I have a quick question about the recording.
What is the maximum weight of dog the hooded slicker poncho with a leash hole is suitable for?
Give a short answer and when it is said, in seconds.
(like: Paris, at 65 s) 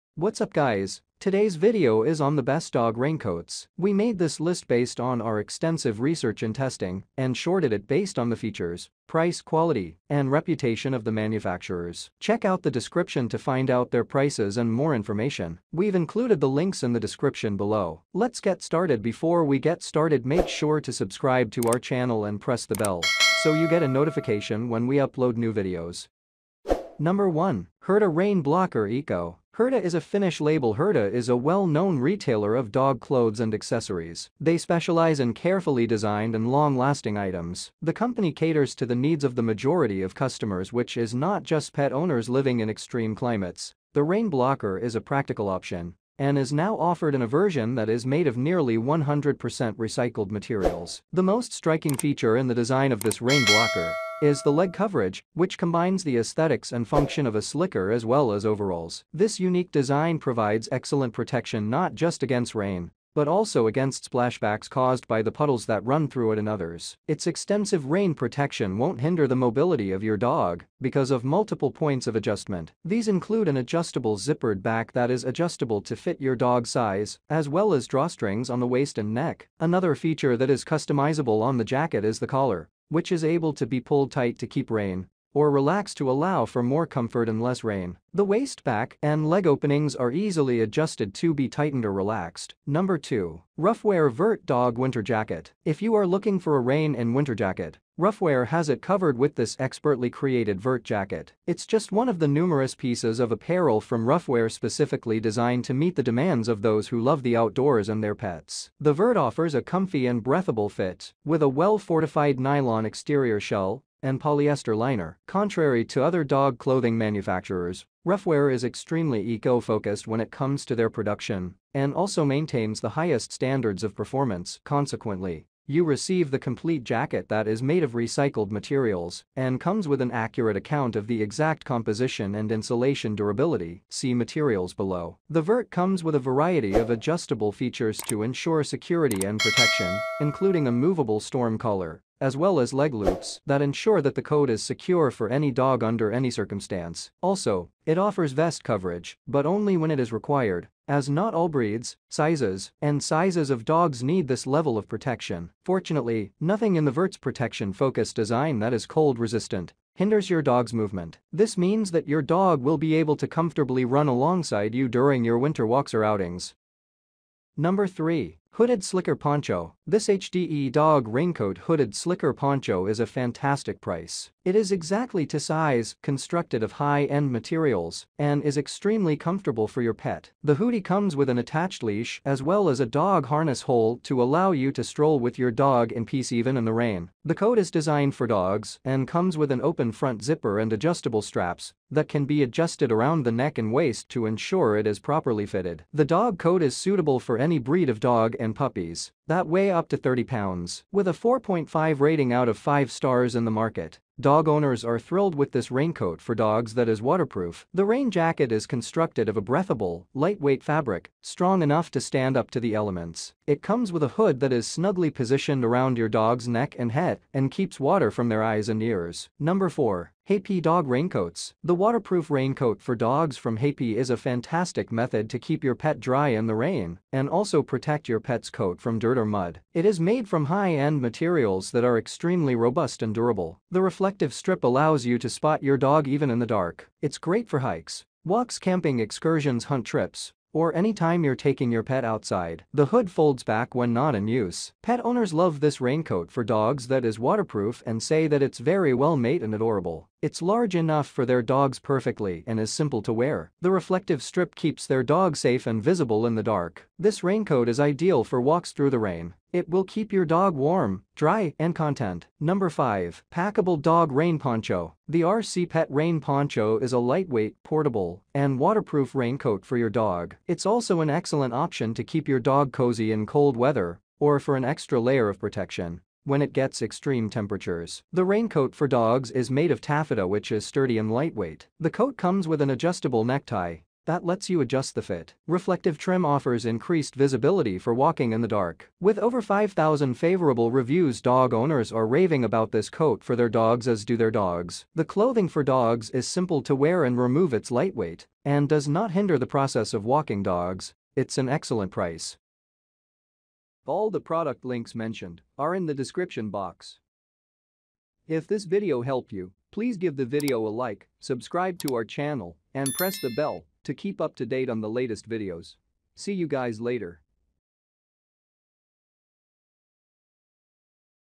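30 pounds, at 199 s.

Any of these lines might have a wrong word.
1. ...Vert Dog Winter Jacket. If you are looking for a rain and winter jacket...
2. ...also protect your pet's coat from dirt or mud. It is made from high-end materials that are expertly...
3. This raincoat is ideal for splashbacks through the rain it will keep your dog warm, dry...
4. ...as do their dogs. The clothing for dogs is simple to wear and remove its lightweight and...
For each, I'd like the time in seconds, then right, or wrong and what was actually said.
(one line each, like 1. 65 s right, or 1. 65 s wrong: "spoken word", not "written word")
1. 94 s right
2. 227 s wrong: "extremely", not "expertly"
3. 256 s wrong: "walks", not "splashbacks"
4. 293 s right.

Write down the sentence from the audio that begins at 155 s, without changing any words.
Fortunately, nothing in the Vert's protection-focused design that is cold-resistant hinders your dog's movement.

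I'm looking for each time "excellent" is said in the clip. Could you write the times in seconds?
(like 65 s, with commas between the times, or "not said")
60 s, 271 s, 301 s.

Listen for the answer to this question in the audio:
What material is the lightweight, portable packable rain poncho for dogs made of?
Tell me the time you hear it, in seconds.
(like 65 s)
279 s.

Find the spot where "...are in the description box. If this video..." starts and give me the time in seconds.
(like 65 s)
305 s.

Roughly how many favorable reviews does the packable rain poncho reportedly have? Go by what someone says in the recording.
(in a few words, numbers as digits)
over 5,000.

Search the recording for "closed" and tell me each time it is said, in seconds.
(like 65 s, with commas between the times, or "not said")
not said.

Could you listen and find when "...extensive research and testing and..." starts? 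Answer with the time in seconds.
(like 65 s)
5 s.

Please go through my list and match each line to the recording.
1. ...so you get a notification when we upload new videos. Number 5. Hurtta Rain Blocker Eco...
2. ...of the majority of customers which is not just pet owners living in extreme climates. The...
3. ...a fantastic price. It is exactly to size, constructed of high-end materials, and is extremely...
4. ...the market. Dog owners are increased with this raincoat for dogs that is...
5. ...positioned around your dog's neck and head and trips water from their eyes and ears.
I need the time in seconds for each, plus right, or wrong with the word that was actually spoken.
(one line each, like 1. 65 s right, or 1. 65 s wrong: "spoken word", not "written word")
1. 23 s wrong: "1", not "5"
2. 39 s right
3. 172 s right
4. 203 s wrong: "thrilled", not "increased"
5. 215 s wrong: "keeps", not "trips".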